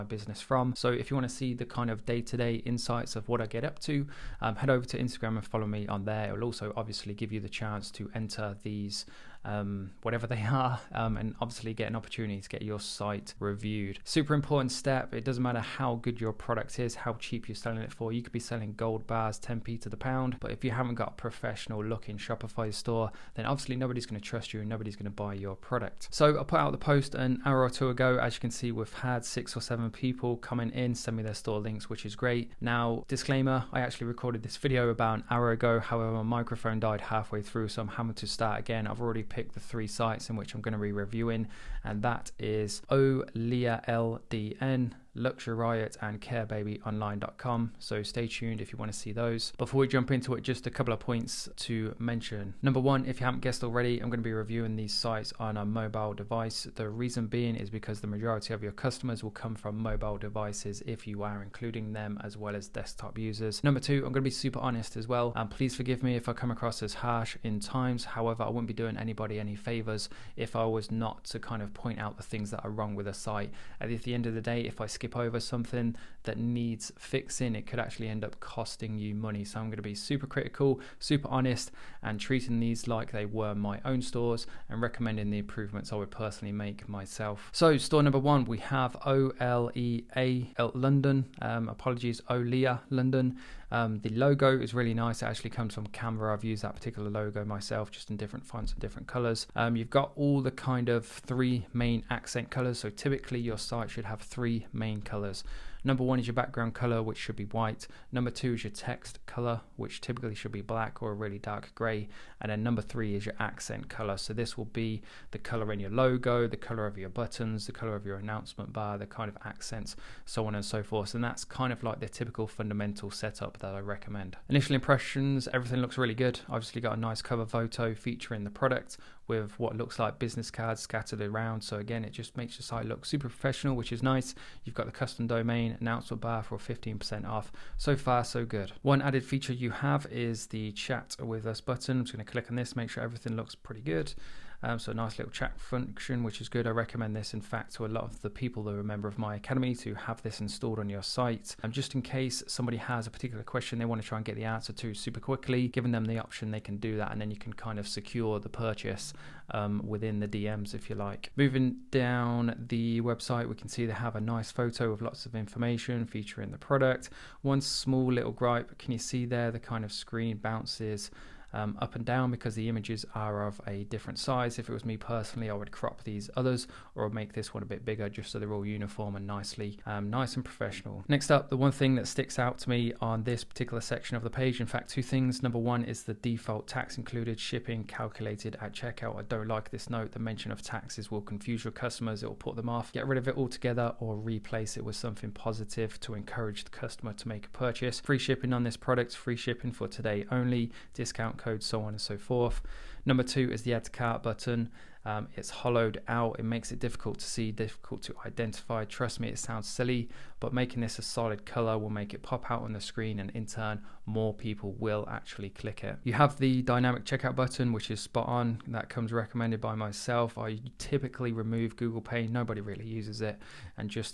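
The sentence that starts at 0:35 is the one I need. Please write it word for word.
However, my microphone died halfway through, so I'm having to start again.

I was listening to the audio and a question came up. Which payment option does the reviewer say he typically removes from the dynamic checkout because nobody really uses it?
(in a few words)
Google Pay.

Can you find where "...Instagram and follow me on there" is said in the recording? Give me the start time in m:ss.
0:04.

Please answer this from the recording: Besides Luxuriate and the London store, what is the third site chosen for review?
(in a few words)
CareBabyOnline.com.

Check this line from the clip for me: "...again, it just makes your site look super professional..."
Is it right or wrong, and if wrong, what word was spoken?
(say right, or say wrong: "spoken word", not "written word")
right.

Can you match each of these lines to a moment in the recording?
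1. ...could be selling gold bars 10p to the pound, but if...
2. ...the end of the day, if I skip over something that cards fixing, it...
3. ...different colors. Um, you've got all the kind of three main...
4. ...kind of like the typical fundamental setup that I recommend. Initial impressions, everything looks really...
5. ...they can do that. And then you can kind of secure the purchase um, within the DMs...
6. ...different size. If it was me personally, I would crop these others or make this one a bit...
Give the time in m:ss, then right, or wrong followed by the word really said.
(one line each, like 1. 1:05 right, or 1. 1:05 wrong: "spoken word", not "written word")
1. 0:18 right
2. 1:14 wrong: "needs", not "cards"
3. 1:38 right
4. 2:01 right
5. 2:36 right
6. 2:53 right.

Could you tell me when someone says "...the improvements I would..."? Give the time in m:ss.
1:25.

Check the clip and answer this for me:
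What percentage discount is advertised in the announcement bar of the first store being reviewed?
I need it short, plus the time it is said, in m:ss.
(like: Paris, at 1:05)
15%, at 2:16.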